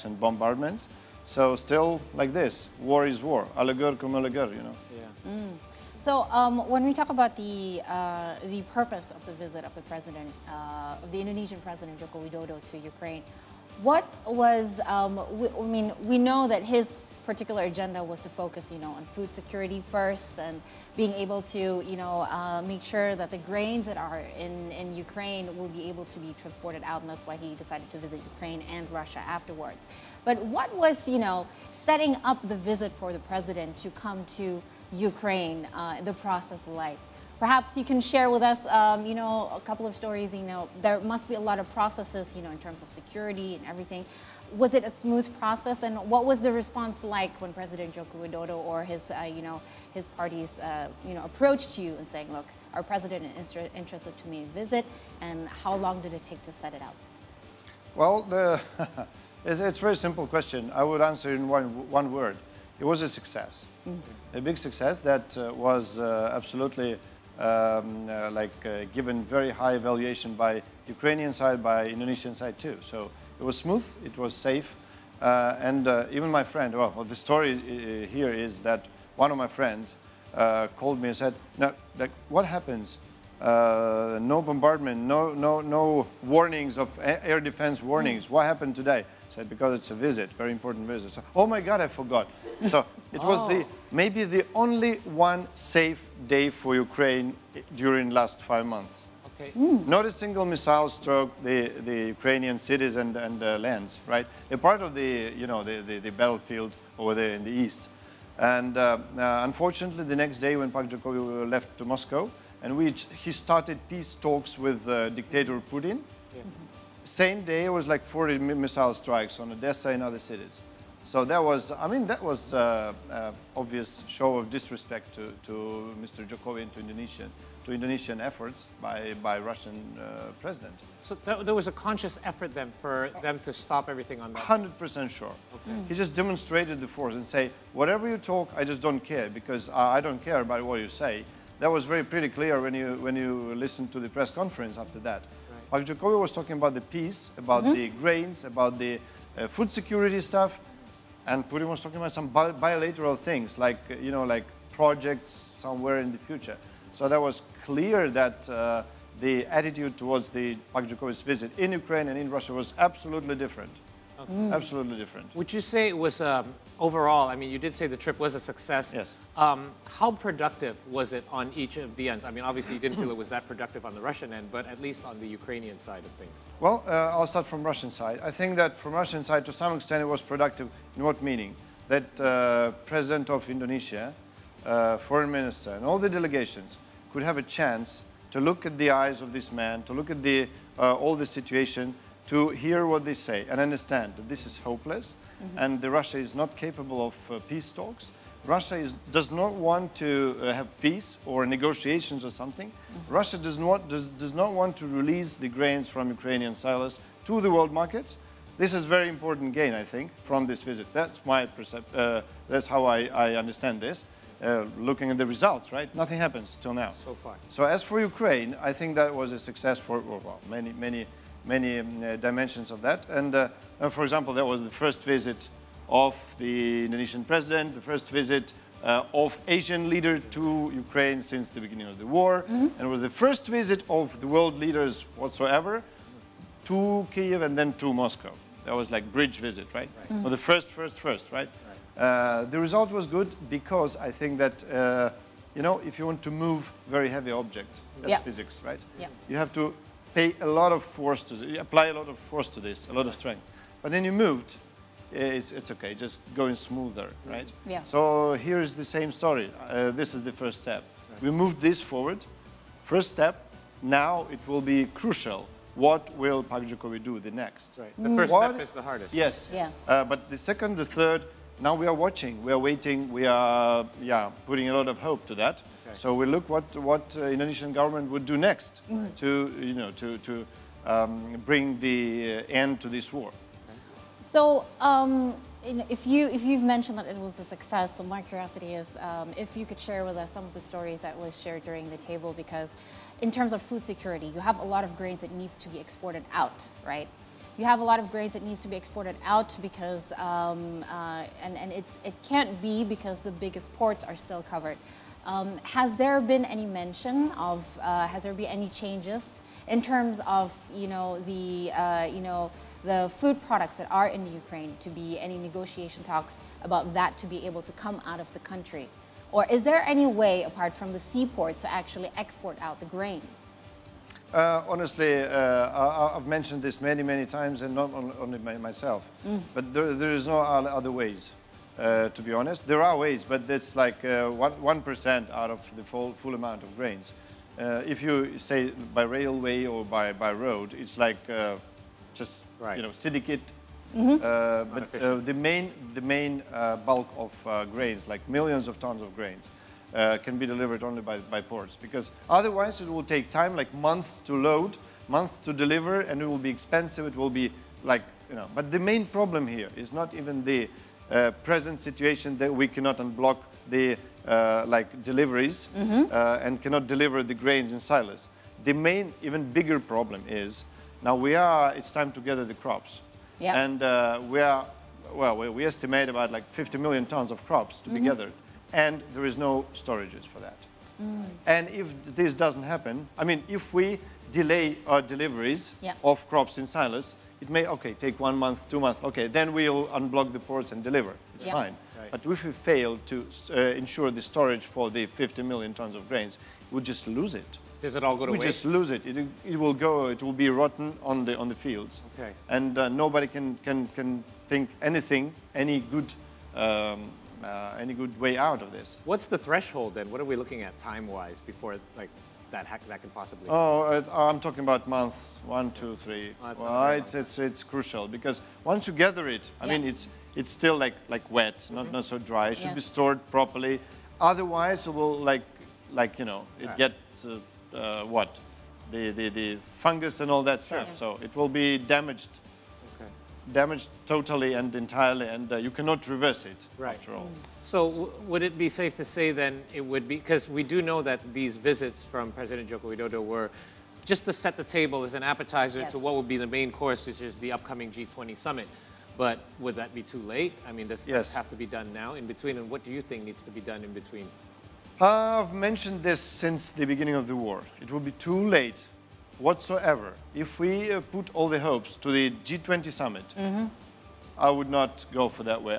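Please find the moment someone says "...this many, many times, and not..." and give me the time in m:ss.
5:26.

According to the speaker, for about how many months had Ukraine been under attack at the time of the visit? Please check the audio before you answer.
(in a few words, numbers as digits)
5.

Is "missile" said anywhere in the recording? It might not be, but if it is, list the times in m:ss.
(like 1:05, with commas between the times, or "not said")
1:40, 1:58.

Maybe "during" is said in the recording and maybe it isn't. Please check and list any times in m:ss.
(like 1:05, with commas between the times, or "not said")
1:37, 4:51.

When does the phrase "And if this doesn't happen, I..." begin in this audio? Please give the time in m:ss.
6:21.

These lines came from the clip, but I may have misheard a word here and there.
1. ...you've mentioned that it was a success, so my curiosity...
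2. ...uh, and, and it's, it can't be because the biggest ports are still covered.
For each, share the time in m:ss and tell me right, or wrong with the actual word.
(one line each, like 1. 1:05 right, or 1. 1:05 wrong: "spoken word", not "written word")
1. 4:46 right
2. 5:00 right.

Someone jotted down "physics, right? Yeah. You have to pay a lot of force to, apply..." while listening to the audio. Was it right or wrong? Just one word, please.
right.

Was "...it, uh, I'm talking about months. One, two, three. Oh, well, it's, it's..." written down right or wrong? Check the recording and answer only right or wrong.
right.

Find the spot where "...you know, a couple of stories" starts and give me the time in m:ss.
0:39.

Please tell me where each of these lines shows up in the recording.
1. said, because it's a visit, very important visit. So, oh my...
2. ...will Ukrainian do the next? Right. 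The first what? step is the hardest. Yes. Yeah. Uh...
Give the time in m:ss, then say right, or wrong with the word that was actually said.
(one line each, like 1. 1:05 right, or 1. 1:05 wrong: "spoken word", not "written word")
1. 1:29 right
2. 4:26 wrong: "Pak", not "Ukrainian".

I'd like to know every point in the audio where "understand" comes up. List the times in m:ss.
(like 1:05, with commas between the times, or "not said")
3:13, 3:33.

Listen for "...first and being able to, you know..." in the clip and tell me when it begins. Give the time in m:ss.
0:19.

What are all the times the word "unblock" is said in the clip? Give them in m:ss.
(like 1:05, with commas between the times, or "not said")
6:02, 6:29.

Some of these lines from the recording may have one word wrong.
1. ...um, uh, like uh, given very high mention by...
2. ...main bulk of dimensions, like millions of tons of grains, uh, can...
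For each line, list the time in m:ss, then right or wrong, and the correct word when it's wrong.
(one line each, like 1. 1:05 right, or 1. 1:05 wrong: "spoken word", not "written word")
1. 1:07 wrong: "valuation", not "mention"
2. 5:46 wrong: "grains", not "dimensions".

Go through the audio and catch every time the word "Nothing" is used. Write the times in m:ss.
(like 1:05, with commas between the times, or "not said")
3:36.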